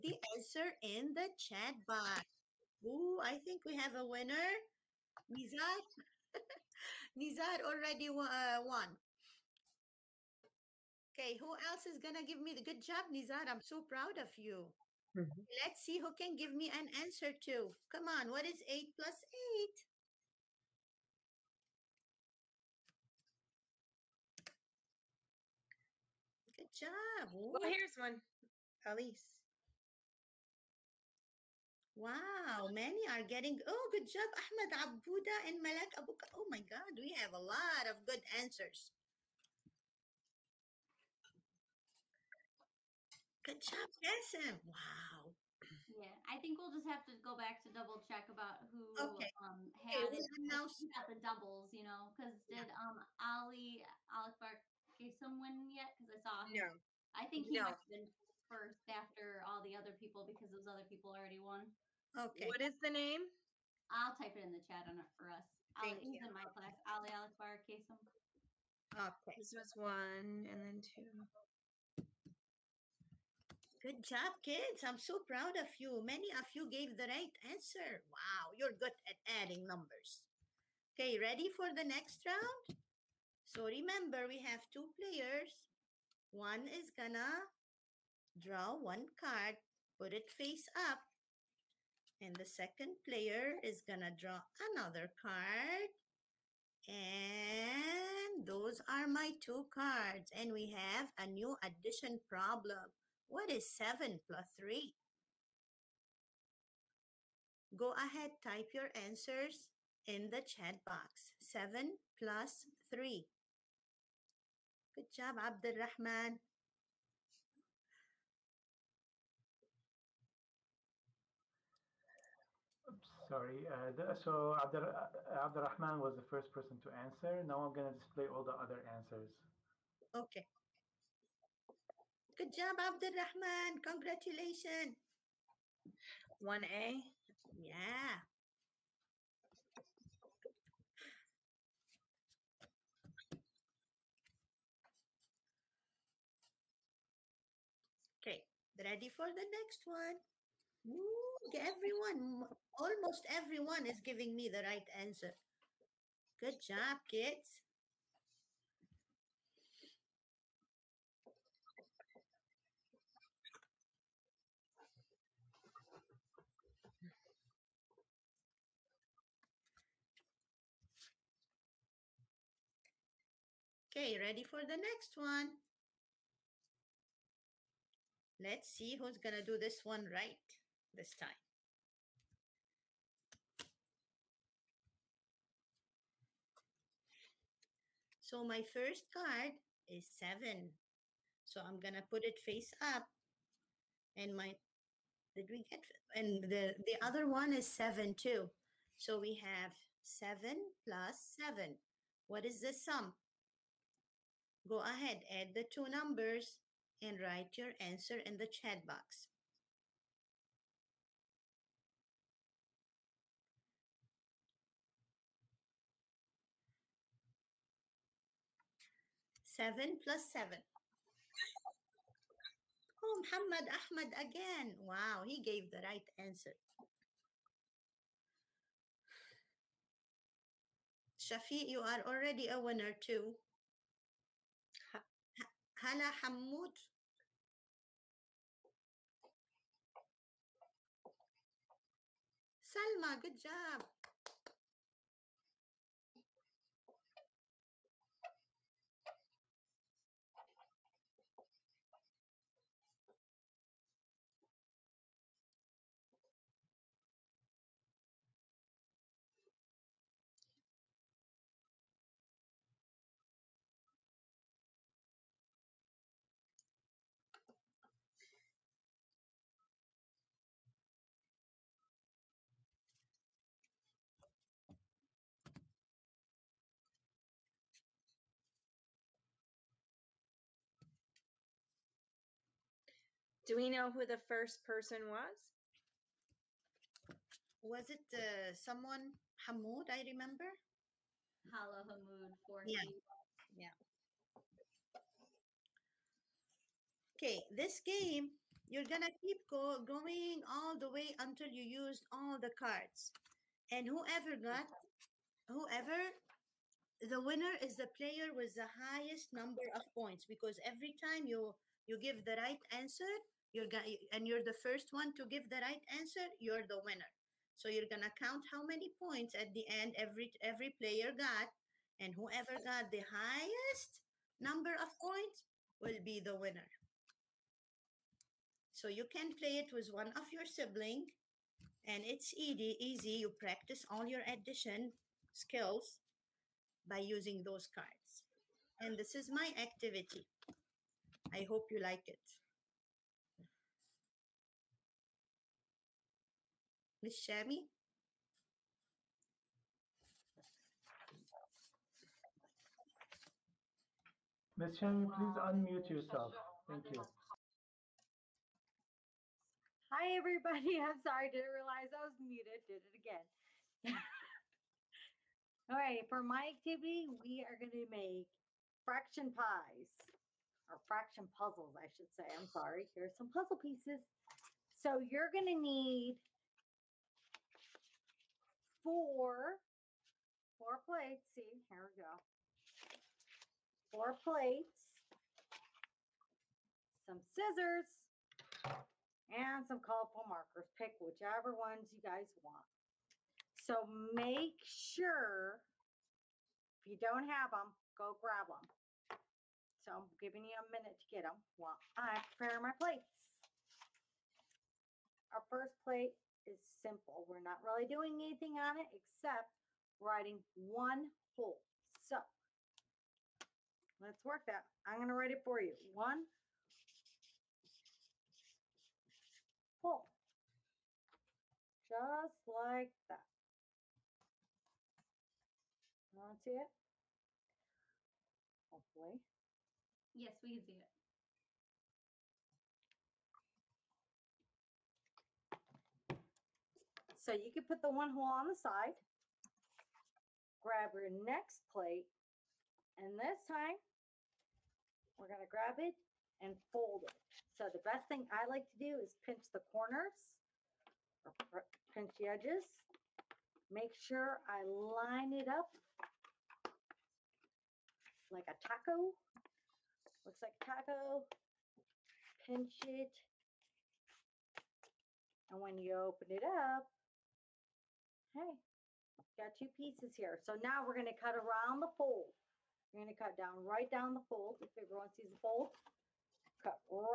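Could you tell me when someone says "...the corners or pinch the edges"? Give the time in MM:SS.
07:29.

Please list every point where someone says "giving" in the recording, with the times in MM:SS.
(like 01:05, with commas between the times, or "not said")
02:34, 06:40.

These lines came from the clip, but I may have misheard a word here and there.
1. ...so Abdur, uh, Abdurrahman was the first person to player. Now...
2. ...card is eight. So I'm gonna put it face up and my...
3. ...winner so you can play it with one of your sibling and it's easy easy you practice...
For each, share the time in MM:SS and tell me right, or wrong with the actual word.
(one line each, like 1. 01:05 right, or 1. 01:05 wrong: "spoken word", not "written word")
1. 02:04 wrong: "answer", not "player"
2. 03:09 wrong: "seven", not "eight"
3. 05:26 right.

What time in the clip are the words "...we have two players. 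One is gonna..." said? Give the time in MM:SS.
01:24.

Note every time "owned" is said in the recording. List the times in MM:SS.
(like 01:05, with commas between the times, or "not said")
not said.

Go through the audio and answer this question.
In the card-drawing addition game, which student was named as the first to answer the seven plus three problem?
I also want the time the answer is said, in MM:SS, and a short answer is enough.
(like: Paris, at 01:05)
Abdul Rahman, at 01:55.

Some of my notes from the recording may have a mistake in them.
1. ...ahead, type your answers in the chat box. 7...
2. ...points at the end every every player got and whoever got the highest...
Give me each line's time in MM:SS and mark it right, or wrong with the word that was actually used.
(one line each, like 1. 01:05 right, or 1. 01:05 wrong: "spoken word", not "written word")
1. 01:47 right
2. 05:18 right.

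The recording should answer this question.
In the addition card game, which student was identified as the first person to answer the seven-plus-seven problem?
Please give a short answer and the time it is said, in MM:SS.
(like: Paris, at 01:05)
Hala Hamoud, at 04:51.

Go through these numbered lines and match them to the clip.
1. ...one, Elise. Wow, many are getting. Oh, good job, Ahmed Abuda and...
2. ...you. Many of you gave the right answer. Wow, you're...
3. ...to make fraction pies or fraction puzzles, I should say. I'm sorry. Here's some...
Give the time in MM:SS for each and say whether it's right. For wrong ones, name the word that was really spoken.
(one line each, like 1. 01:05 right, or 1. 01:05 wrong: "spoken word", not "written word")
1. 00:27 right
2. 01:15 right
3. 06:07 right.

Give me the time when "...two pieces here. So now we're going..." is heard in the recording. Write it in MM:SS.
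07:49.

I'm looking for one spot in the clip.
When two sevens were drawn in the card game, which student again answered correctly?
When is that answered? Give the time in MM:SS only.
03:43.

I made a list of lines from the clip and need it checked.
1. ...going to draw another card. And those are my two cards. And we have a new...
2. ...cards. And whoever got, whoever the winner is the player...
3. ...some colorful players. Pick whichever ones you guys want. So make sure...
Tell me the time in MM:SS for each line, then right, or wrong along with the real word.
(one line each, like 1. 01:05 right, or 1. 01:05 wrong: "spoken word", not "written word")
1. 01:33 right
2. 05:02 right
3. 06:29 wrong: "markers", not "players".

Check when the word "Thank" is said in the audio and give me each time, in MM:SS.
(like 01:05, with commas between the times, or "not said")
01:05, 05:56.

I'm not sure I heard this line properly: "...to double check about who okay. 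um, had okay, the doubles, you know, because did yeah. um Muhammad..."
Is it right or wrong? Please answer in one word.
wrong.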